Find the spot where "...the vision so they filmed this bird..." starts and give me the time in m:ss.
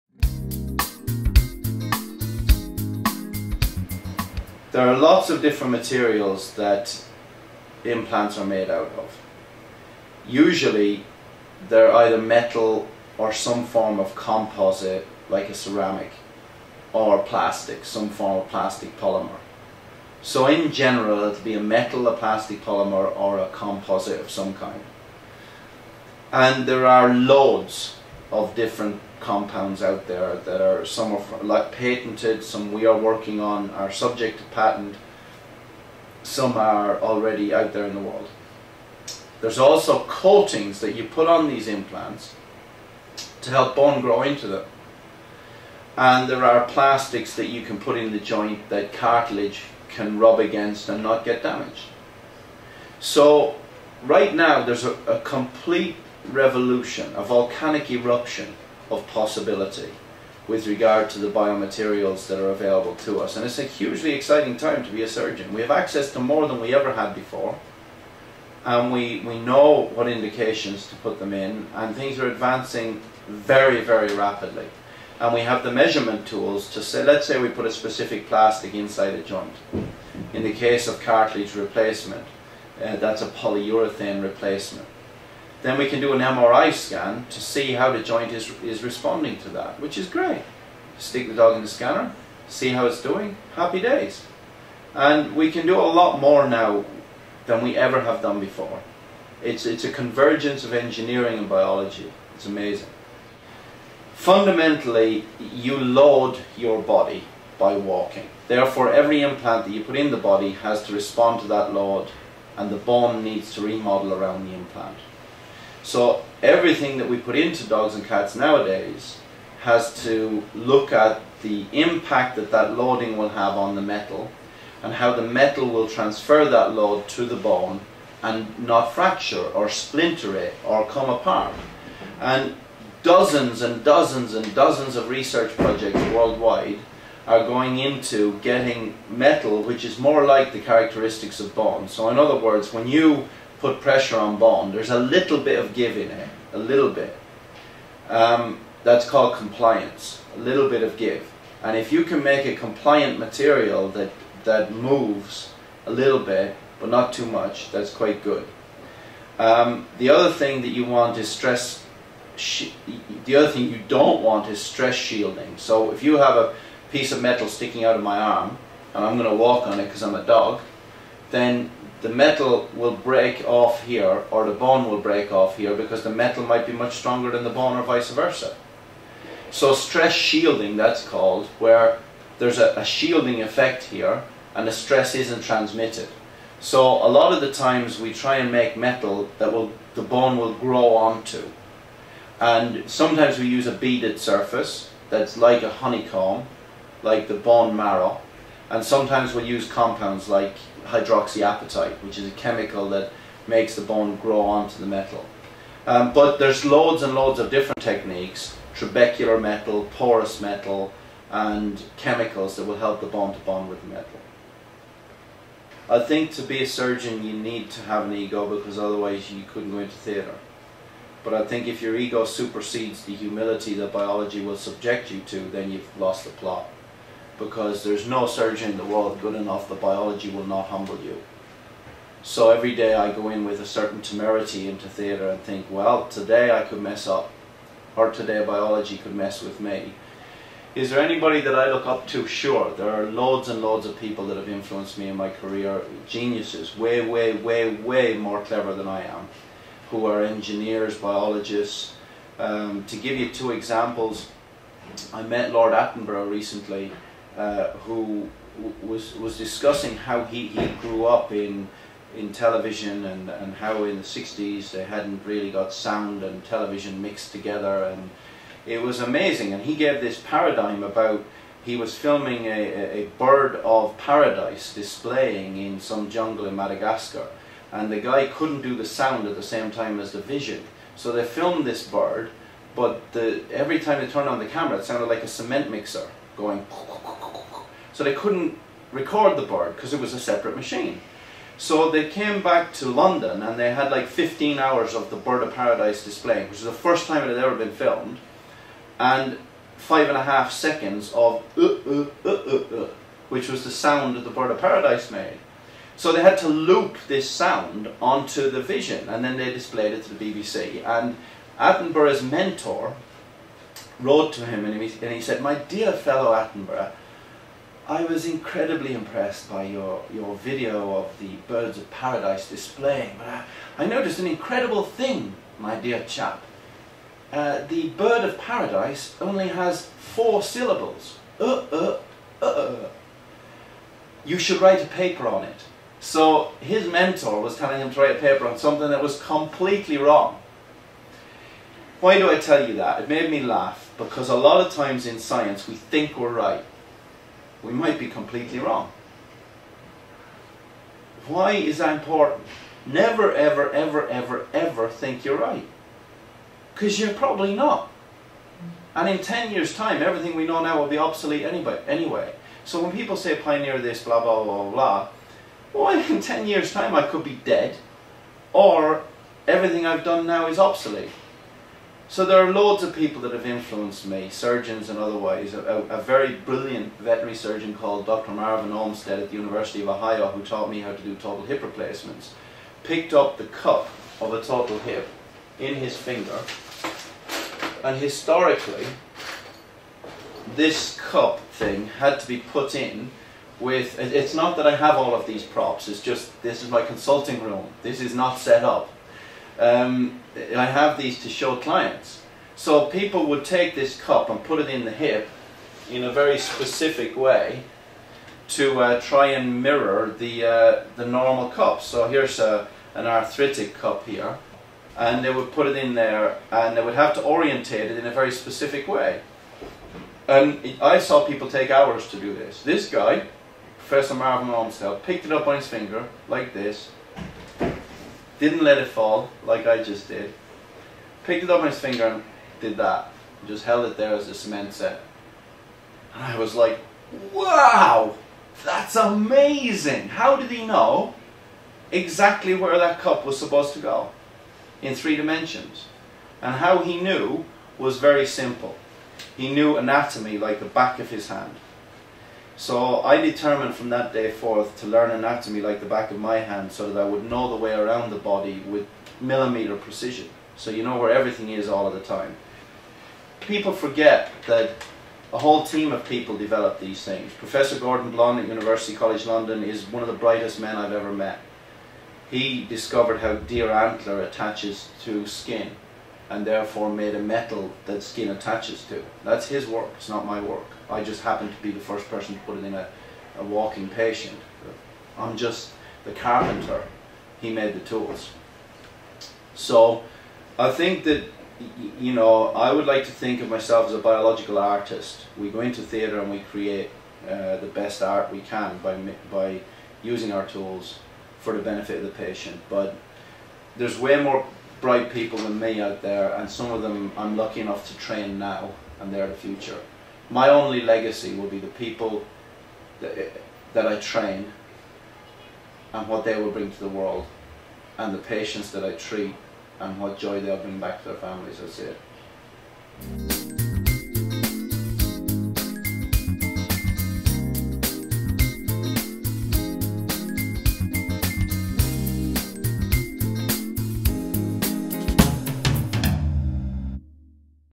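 4:40.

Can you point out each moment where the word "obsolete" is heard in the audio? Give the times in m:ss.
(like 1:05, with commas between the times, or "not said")
6:00, 6:10.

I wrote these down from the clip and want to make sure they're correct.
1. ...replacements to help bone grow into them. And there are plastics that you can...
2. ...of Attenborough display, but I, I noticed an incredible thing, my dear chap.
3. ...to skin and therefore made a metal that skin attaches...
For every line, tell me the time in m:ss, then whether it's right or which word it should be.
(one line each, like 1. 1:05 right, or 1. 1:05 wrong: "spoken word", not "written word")
1. 0:41 wrong: "implants", not "replacements"
2. 5:21 wrong: "Paradise", not "Attenborough"
3. 7:55 right.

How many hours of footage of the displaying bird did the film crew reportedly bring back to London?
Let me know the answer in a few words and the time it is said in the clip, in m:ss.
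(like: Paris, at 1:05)
15, at 4:54.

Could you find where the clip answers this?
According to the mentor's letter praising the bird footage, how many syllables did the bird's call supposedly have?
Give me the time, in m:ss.
5:29.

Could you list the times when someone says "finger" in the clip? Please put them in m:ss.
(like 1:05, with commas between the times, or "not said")
6:25, 7:05, 7:11.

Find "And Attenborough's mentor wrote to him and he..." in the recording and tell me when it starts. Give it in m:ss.
5:10.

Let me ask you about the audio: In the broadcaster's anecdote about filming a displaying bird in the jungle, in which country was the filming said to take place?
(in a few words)
Madagascar.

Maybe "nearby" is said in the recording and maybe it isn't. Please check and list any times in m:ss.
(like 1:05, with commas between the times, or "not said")
not said.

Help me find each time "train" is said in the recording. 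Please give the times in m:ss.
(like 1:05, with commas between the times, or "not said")
8:27, 8:33.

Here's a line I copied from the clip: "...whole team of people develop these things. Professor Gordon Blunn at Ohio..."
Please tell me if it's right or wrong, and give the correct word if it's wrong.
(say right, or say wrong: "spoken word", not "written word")
wrong: "University", not "Ohio".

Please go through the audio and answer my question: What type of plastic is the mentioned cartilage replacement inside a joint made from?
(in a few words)
polyurethane.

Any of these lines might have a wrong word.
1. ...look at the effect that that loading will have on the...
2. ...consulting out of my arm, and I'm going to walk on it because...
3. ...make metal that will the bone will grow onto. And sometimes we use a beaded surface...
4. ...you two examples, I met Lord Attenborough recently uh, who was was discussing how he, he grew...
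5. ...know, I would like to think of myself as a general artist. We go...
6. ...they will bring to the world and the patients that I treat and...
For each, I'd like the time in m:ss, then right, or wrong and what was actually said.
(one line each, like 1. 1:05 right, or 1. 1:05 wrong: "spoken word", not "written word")
1. 2:00 wrong: "impact", not "effect"
2. 2:47 wrong: "sticking", not "consulting"
3. 3:08 right
4. 4:13 right
5. 8:12 wrong: "biological", not "general"
6. 8:36 right.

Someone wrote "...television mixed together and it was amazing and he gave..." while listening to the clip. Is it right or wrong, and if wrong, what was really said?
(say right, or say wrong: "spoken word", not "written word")
right.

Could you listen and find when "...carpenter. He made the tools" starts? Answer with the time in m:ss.
8:06.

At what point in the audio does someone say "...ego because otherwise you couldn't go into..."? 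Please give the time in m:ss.
3:38.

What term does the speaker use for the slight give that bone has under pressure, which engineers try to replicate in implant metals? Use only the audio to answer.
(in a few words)
compliance.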